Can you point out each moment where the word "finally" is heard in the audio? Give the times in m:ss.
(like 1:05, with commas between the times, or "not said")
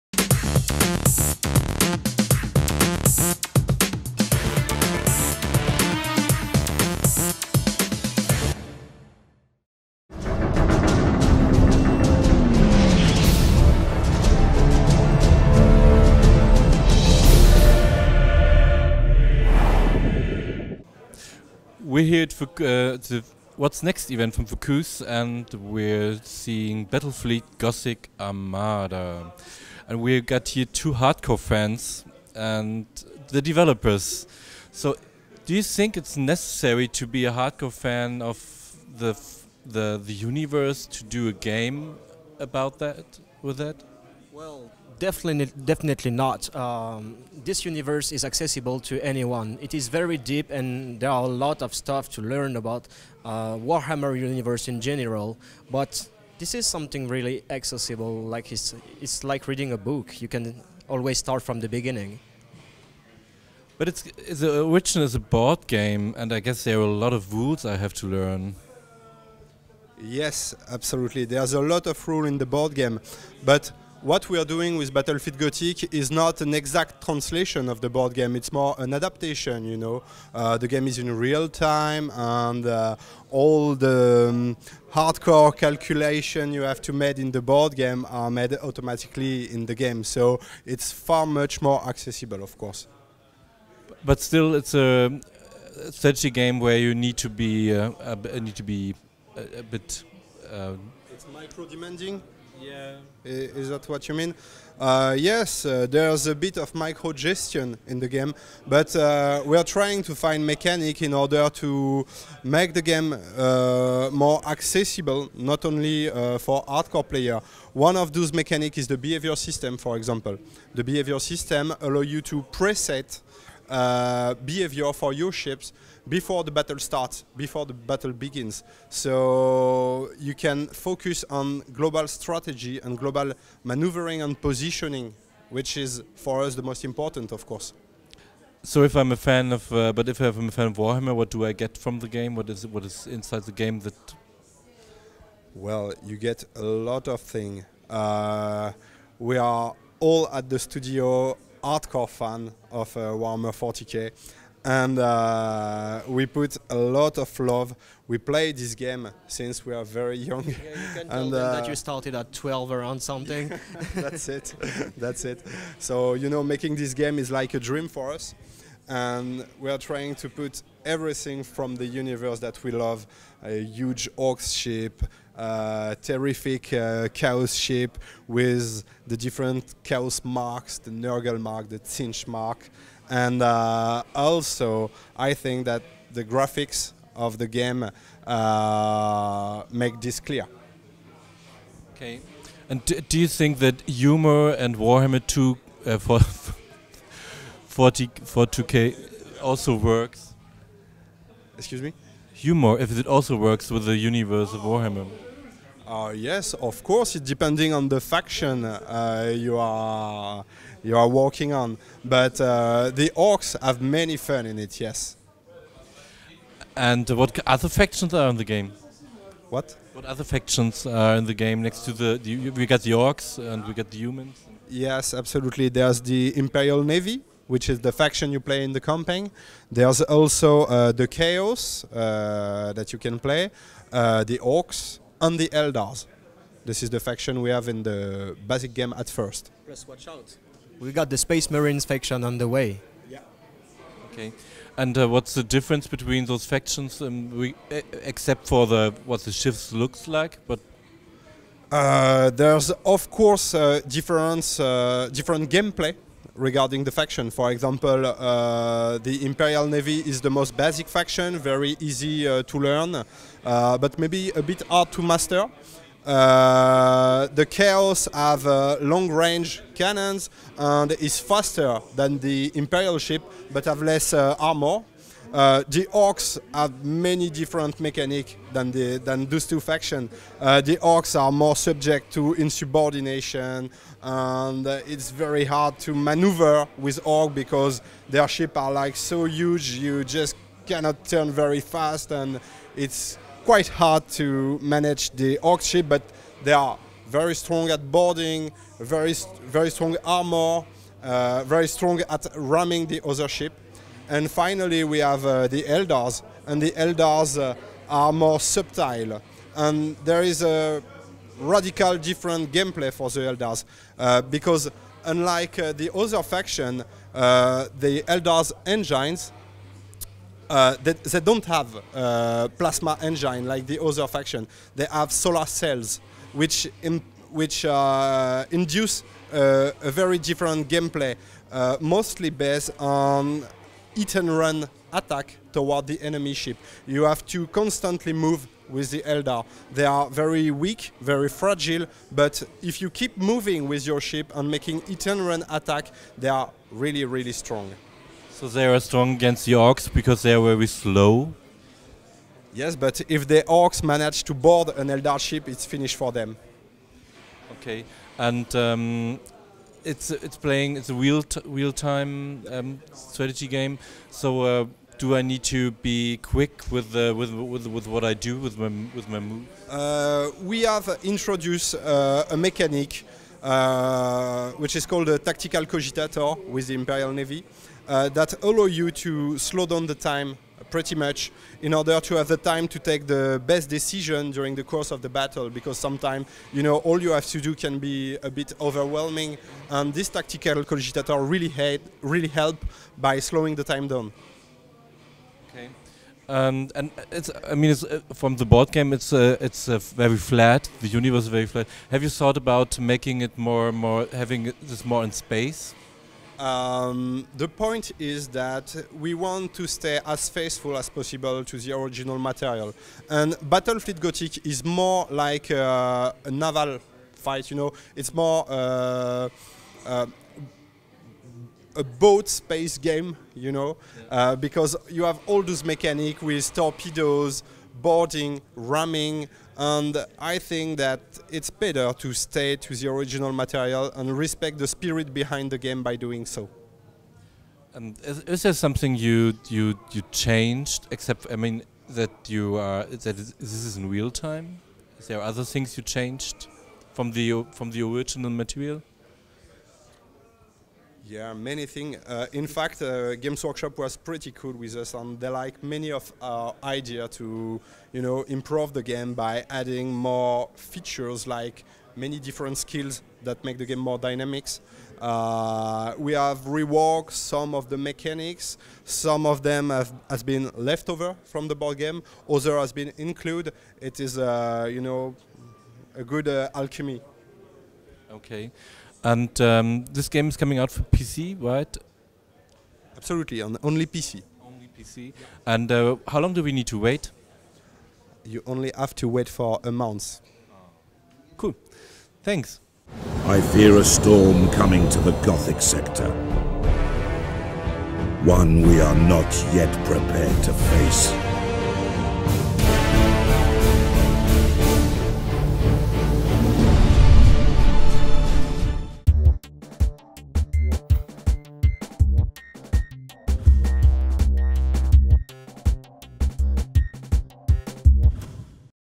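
5:04.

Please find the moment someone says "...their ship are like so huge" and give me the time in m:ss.
4:48.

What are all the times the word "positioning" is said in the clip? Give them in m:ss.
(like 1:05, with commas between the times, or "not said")
2:14.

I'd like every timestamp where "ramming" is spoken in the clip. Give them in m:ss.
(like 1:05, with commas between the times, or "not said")
5:02, 7:08.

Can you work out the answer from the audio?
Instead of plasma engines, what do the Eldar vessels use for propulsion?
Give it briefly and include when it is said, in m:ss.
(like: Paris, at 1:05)
solar cells, at 5:25.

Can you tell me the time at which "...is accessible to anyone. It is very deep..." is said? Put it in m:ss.
0:48.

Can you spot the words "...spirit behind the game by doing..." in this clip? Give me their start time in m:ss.
7:14.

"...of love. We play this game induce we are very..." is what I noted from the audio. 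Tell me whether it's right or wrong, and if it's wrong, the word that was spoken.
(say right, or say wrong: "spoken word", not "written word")
wrong: "since", not "induce".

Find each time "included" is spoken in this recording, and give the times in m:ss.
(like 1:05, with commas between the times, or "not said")
7:52.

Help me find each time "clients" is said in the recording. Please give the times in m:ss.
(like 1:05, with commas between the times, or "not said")
not said.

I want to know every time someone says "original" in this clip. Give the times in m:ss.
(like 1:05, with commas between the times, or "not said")
6:51, 7:12, 7:27.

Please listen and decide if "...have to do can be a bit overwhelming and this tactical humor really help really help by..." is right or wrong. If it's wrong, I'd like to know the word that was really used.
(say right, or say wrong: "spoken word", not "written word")
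wrong: "cogitator", not "humor".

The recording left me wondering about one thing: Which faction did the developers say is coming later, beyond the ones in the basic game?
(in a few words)
Space Marines.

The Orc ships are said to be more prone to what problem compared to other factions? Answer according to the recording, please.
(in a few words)
insubordination.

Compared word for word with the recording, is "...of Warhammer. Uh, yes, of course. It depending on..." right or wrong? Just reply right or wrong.
right.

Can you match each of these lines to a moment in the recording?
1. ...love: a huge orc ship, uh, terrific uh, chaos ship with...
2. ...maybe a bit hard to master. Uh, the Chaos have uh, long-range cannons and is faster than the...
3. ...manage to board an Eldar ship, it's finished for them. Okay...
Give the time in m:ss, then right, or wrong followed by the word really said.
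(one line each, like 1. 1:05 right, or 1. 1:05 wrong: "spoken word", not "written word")
1. 2:52 right
2. 4:23 right
3. 5:53 right.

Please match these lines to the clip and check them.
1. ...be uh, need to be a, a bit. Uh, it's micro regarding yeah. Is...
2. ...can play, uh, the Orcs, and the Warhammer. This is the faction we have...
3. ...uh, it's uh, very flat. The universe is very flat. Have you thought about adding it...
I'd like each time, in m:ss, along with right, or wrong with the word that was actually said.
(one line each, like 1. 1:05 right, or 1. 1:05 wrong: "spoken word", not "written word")
1. 1:37 wrong: "demanding", not "regarding"
2. 3:52 wrong: "Eldars", not "Warhammer"
3. 6:39 wrong: "making", not "adding".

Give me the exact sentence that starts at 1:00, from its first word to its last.
You can always start from the beginning.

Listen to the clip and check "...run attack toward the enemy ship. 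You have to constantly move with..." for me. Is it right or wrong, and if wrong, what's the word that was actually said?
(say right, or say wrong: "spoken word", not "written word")
right.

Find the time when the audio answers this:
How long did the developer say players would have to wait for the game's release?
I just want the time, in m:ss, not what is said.
8:09.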